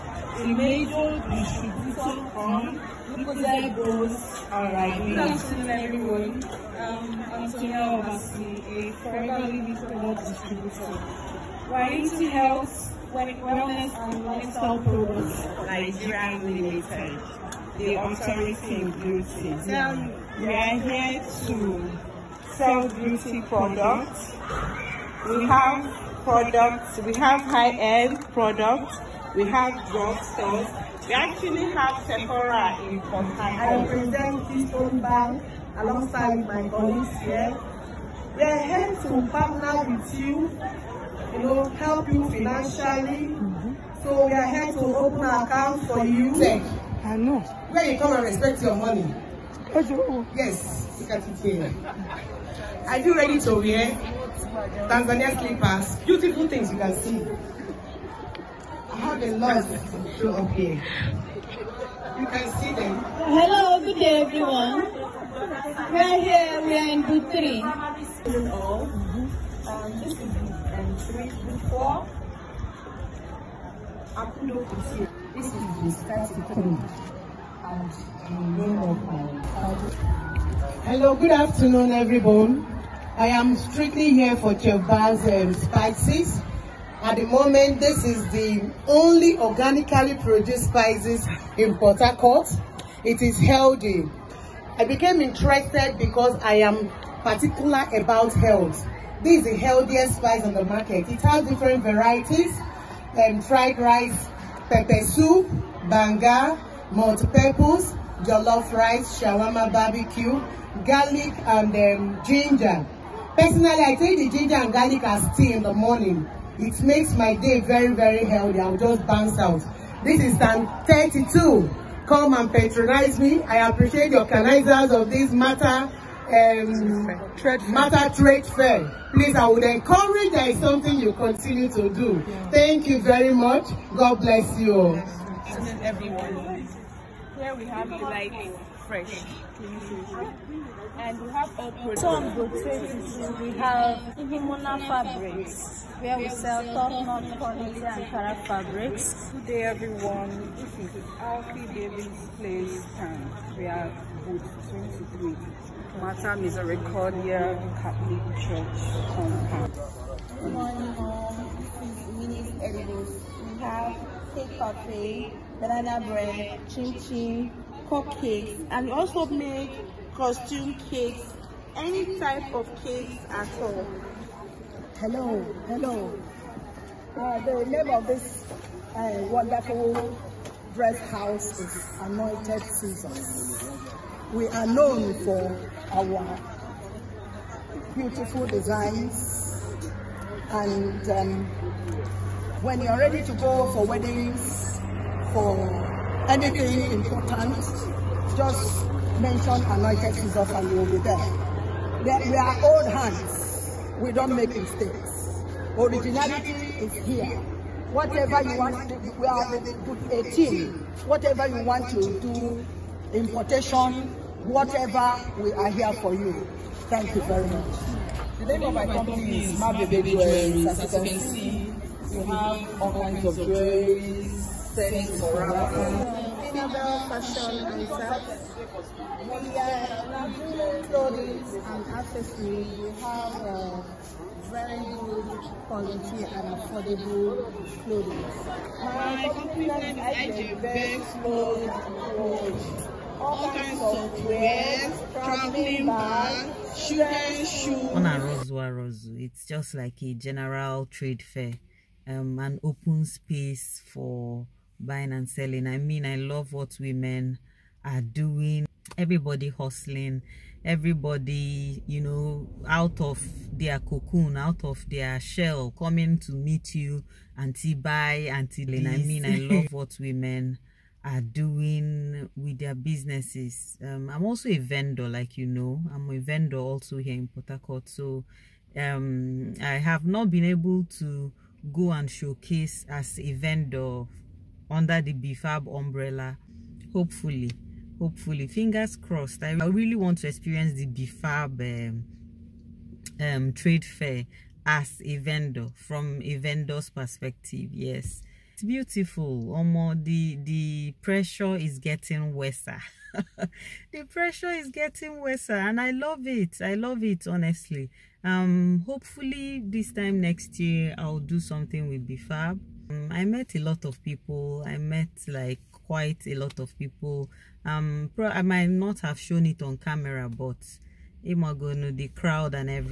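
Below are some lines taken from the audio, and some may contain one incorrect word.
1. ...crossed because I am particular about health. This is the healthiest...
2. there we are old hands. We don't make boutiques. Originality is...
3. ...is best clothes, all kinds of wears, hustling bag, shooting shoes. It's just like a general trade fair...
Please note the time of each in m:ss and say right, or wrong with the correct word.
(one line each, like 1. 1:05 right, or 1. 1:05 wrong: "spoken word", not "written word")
1. 1:35 wrong: "interested", not "crossed"
2. 3:22 wrong: "mistakes", not "boutiques"
3. 3:59 wrong: "traveling", not "hustling".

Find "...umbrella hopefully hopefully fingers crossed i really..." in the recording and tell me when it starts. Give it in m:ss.
4:45.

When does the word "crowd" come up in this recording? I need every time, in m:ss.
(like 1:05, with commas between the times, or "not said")
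5:22.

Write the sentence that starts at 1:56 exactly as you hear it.
It makes my day very, very healthy.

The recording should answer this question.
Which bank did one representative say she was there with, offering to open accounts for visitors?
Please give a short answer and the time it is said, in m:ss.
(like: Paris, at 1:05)
Keystone Bank, at 0:34.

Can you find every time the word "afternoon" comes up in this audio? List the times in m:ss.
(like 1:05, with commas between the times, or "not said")
0:05, 1:21.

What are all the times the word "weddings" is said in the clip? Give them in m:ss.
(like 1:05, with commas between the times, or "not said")
3:13.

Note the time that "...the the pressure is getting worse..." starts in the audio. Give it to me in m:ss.
5:00.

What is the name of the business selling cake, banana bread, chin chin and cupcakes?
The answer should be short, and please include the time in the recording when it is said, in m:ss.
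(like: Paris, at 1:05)
Winnie's Edibles, at 2:42.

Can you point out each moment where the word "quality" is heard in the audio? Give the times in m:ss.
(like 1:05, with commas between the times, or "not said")
2:27, 3:55.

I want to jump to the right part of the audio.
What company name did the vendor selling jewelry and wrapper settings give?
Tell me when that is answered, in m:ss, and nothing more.
3:39.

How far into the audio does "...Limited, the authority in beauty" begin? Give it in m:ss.
0:16.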